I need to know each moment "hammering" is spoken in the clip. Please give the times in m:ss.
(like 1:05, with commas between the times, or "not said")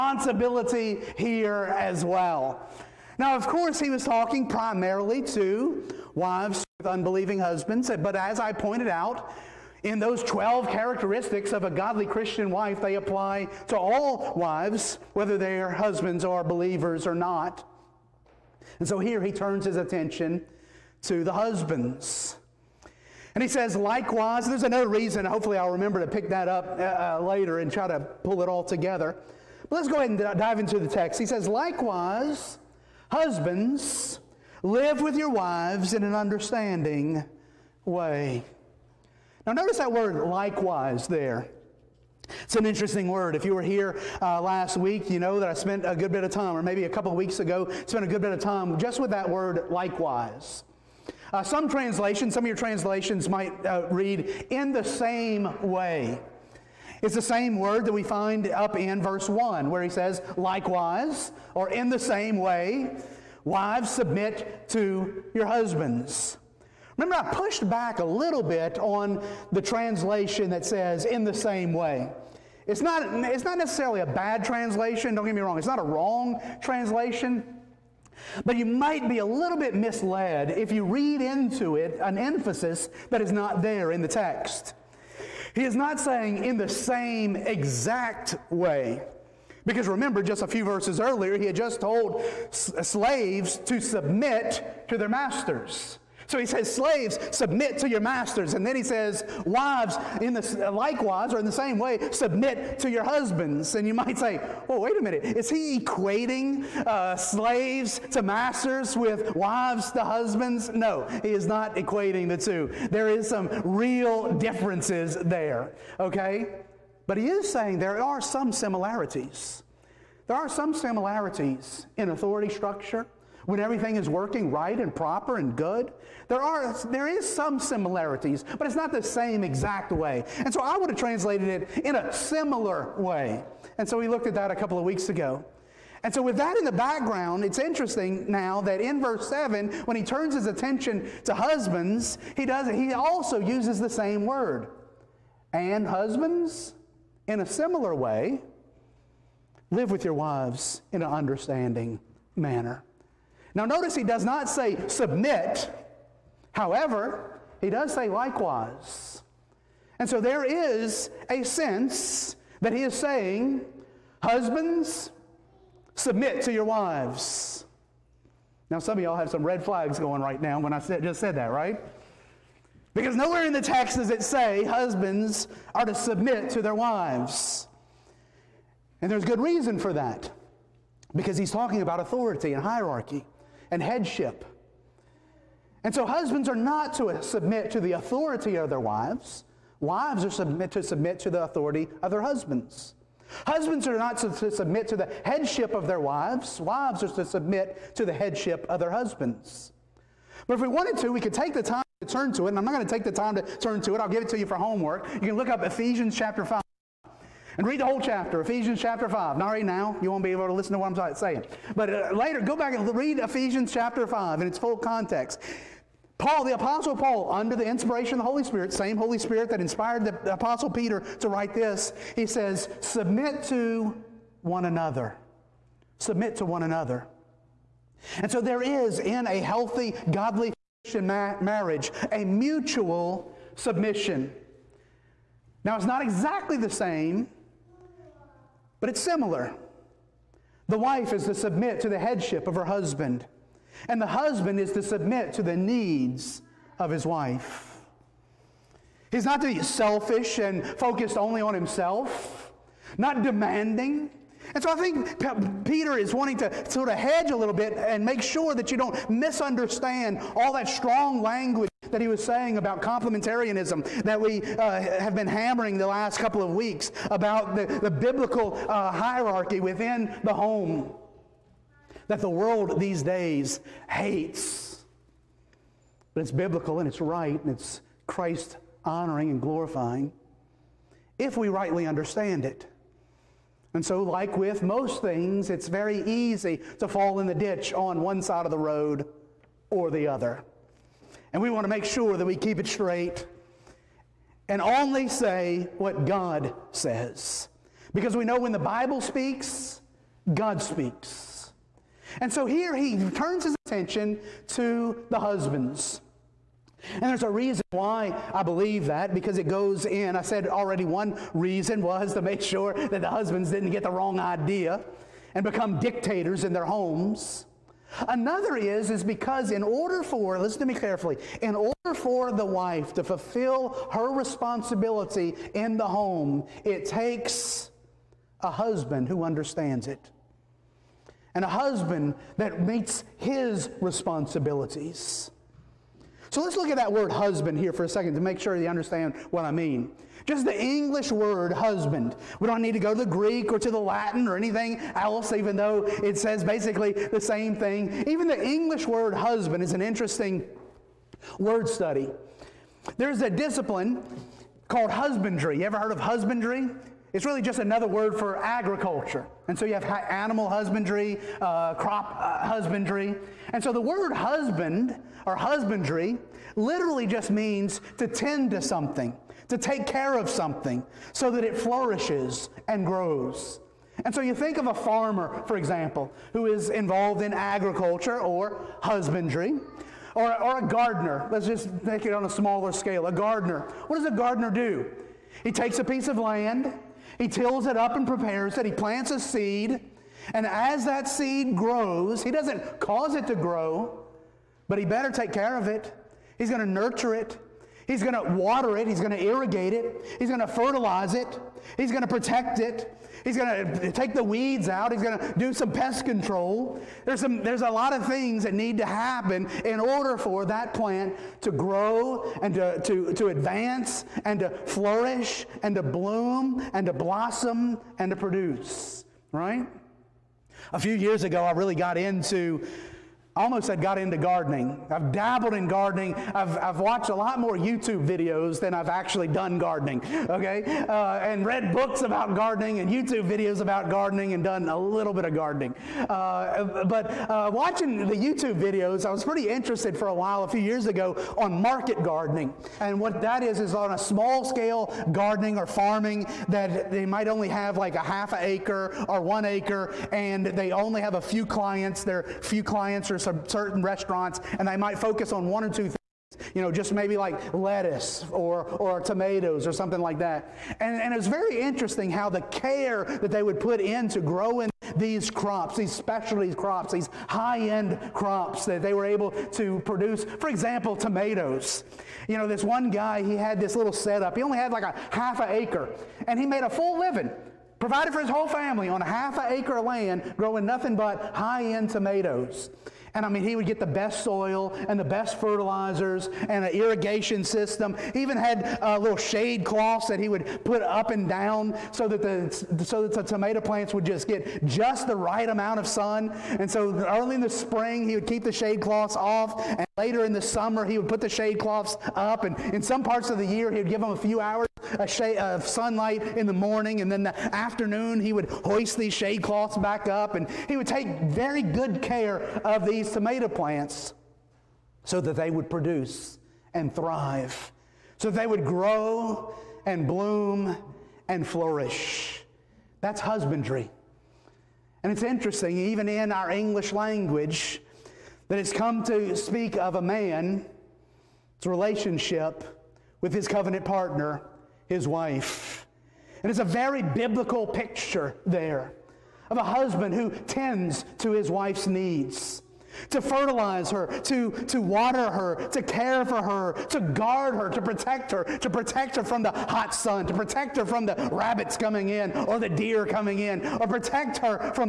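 4:25.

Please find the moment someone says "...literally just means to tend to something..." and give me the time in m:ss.
6:06.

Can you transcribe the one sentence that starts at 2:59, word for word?
And there's good reason for that.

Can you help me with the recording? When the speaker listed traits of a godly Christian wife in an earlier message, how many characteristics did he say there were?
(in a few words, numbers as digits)
12.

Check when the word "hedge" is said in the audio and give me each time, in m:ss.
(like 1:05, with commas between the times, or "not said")
4:16.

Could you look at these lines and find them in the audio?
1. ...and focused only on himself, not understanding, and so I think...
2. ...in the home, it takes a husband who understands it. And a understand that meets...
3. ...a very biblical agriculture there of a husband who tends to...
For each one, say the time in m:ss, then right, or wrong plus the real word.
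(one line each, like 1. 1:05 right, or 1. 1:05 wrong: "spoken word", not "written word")
1. 4:10 wrong: "demanding", not "understanding"
2. 5:25 wrong: "husband", not "understand"
3. 8:56 wrong: "picture", not "agriculture".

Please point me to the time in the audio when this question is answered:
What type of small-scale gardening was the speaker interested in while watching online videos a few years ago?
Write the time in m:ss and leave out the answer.
7:21.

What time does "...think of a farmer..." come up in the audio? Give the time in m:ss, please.
6:14.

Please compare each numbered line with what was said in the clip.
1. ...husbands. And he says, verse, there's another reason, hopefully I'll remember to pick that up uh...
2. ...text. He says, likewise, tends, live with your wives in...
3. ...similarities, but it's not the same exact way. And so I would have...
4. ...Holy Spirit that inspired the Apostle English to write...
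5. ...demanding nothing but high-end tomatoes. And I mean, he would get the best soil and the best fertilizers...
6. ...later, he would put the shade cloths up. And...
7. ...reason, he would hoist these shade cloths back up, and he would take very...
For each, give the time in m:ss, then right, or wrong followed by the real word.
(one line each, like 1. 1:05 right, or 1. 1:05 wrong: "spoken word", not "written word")
1. 0:21 wrong: "likewise", not "verse"
2. 0:30 wrong: "husbands", not "tends"
3. 2:07 right
4. 3:38 wrong: "Peter", not "English"
5. 8:00 wrong: "growing", not "demanding"
6. 8:20 wrong: "summer", not "later"
7. 8:27 wrong: "afternoon", not "reason".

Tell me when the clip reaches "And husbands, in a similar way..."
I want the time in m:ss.
2:25.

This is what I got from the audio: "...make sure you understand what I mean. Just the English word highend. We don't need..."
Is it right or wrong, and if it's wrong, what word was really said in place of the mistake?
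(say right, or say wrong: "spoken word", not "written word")
wrong: "husband", not "highend".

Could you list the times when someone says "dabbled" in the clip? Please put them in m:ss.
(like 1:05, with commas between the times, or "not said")
7:05.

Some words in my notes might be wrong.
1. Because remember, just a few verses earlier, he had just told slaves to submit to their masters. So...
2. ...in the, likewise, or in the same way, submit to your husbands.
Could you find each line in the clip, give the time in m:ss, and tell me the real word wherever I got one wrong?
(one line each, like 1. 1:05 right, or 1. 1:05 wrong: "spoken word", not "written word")
1. 1:29 right
2. 1:40 right.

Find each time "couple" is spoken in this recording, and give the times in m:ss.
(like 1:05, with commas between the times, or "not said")
0:46, 2:14, 4:26.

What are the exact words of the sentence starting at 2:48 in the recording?
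Now, some of y'all have some red flags going right now when I said, just said that, right?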